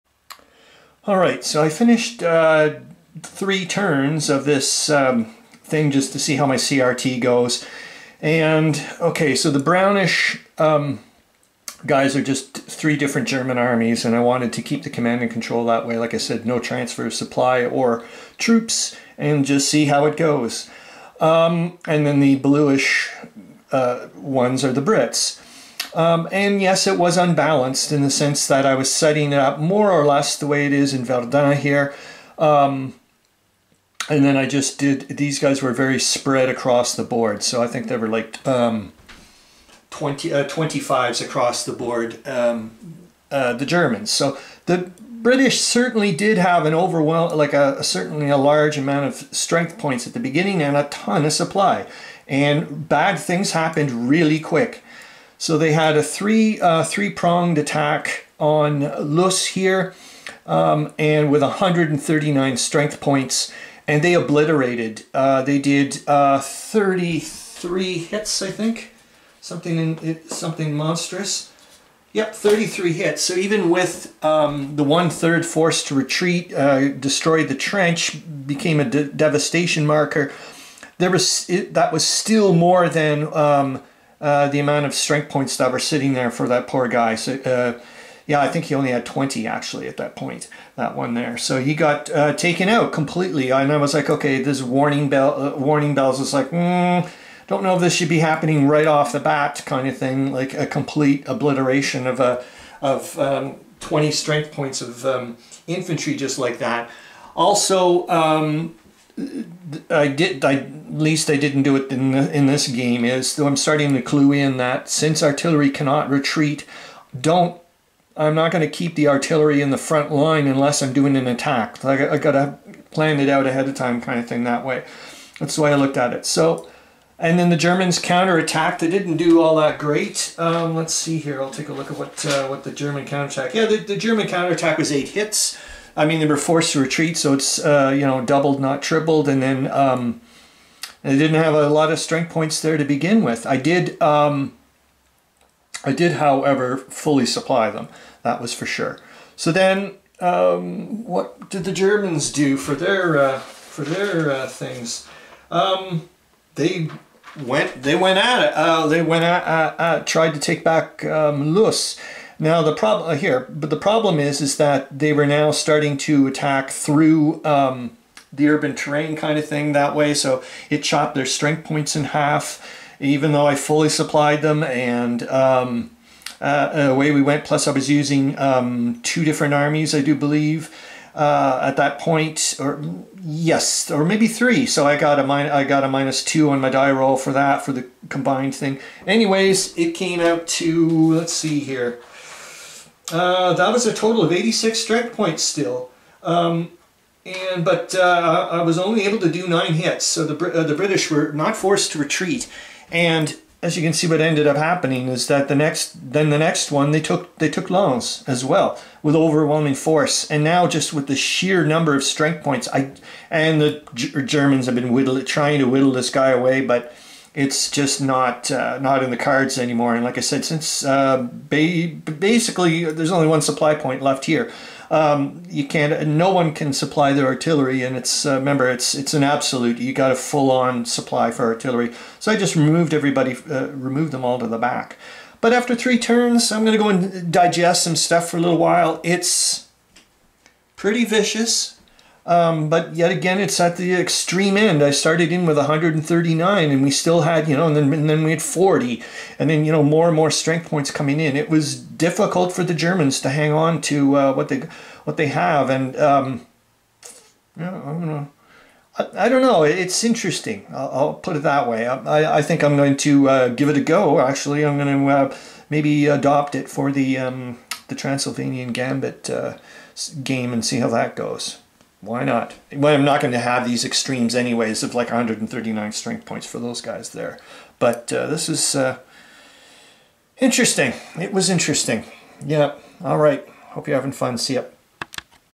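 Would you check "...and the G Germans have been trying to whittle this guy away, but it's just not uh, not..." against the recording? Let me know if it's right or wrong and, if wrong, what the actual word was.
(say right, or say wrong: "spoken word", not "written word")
right.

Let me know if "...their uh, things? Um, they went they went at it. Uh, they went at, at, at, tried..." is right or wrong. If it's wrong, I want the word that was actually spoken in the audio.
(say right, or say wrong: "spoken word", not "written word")
right.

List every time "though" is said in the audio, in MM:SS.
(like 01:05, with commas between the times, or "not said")
01:53, 02:53.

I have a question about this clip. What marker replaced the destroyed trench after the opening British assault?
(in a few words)
devastation marker.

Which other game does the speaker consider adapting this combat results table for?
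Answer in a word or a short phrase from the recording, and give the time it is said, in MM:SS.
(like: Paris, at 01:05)
Transylvanian Gambit, at 04:27.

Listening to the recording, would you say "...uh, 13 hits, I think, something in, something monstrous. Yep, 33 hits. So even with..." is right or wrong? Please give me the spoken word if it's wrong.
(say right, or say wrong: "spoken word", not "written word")
wrong: "33", not "13".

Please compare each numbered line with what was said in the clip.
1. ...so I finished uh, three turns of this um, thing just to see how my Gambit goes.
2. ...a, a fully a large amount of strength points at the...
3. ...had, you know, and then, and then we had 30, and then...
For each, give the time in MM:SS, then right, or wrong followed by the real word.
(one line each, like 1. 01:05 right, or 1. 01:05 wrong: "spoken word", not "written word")
1. 00:01 wrong: "CRT", not "Gambit"
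2. 00:47 wrong: "certainly", not "fully"
3. 04:07 wrong: "40", not "30".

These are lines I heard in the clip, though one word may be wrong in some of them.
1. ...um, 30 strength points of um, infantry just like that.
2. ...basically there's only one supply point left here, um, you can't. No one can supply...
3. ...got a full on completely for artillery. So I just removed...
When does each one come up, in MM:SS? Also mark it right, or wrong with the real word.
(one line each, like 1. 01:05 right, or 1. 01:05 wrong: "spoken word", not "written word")
1. 01:43 wrong: "20", not "30"
2. 03:42 right
3. 03:49 wrong: "supply", not "completely".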